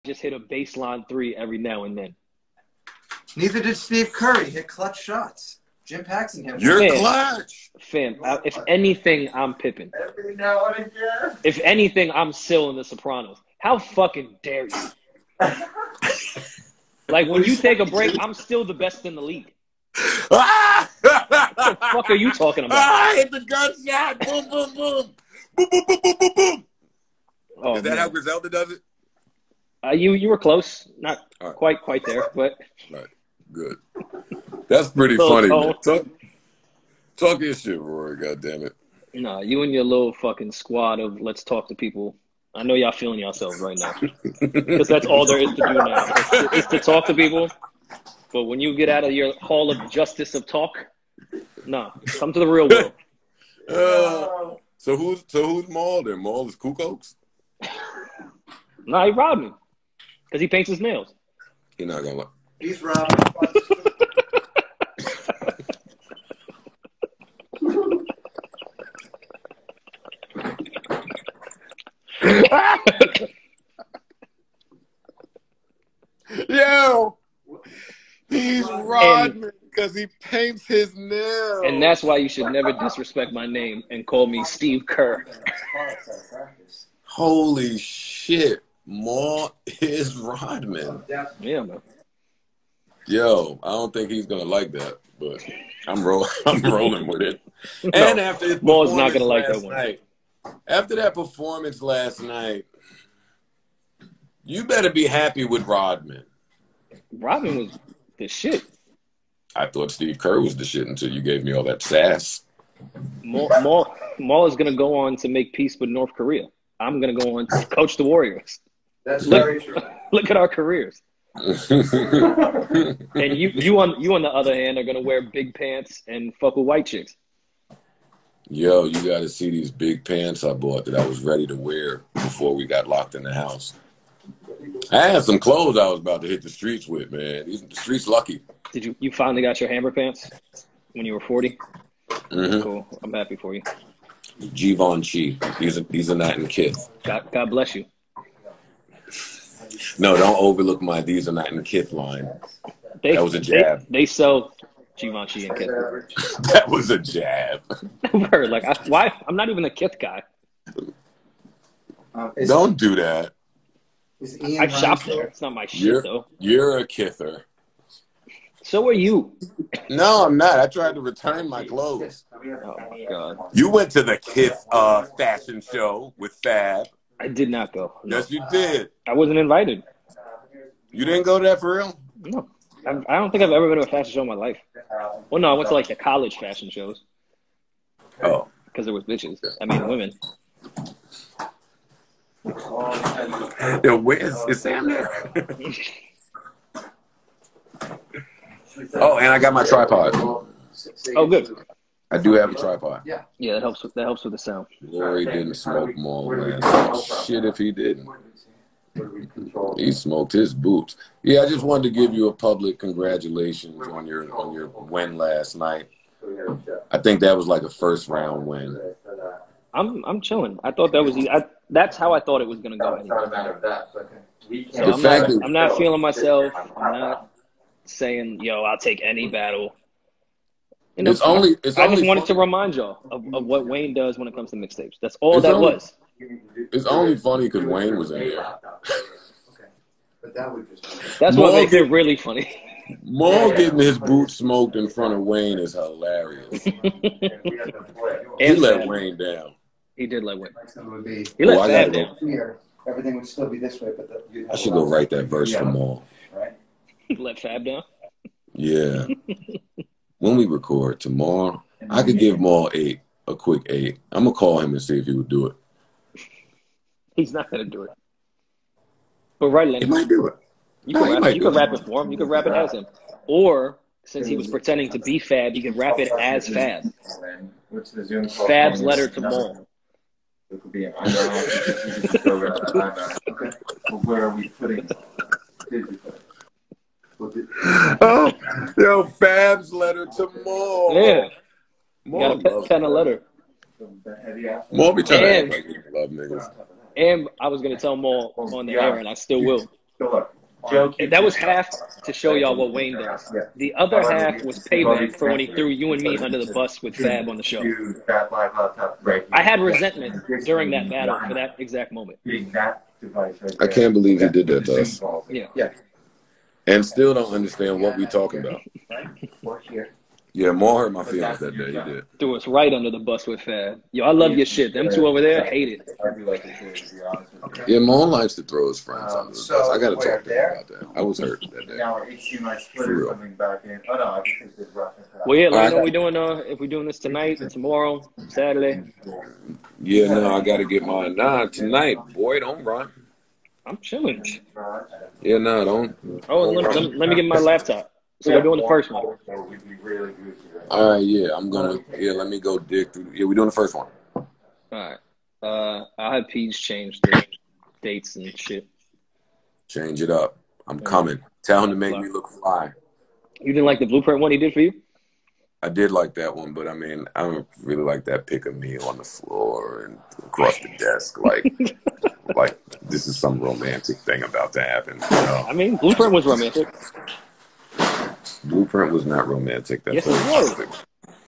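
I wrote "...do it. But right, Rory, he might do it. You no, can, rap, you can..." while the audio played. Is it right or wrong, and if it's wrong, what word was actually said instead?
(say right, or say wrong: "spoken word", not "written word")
wrong: "Lenny", not "Rory".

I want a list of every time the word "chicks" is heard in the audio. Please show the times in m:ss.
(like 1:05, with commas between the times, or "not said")
2:06.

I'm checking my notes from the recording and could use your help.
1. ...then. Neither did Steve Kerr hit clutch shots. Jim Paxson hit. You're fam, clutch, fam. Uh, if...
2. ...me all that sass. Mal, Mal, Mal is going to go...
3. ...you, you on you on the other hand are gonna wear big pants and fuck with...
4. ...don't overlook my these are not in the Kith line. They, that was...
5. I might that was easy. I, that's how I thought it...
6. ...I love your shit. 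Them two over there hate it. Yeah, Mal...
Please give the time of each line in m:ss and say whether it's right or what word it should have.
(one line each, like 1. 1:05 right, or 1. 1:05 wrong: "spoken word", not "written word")
1. 0:01 right
2. 1:51 right
3. 2:03 right
4. 2:30 right
5. 3:40 wrong: "thought", not "might"
6. 5:24 right.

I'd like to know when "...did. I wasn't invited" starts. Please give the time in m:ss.
2:58.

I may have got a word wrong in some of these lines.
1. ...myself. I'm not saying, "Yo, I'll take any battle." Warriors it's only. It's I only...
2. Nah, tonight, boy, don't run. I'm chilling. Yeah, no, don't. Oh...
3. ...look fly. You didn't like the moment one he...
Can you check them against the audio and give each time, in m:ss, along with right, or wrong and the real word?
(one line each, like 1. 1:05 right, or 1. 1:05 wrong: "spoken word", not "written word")
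1. 3:46 wrong: "And", not "Warriors"
2. 5:41 right
3. 6:02 wrong: "blueprint", not "moment".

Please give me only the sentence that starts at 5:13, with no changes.
I can't believe he did that to us.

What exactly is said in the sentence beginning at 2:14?
I had some clothes I was about to hit the streets with, man.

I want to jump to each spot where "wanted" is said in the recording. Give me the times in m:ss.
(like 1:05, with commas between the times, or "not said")
3:31, 3:52.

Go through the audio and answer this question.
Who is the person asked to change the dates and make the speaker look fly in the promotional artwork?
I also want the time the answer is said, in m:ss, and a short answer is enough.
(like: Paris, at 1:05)
Peach, at 5:56.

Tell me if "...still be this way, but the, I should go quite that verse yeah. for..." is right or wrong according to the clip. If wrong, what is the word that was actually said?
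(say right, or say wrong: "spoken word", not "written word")
wrong: "write", not "quite".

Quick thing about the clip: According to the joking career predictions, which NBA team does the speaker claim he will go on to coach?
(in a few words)
Warriors.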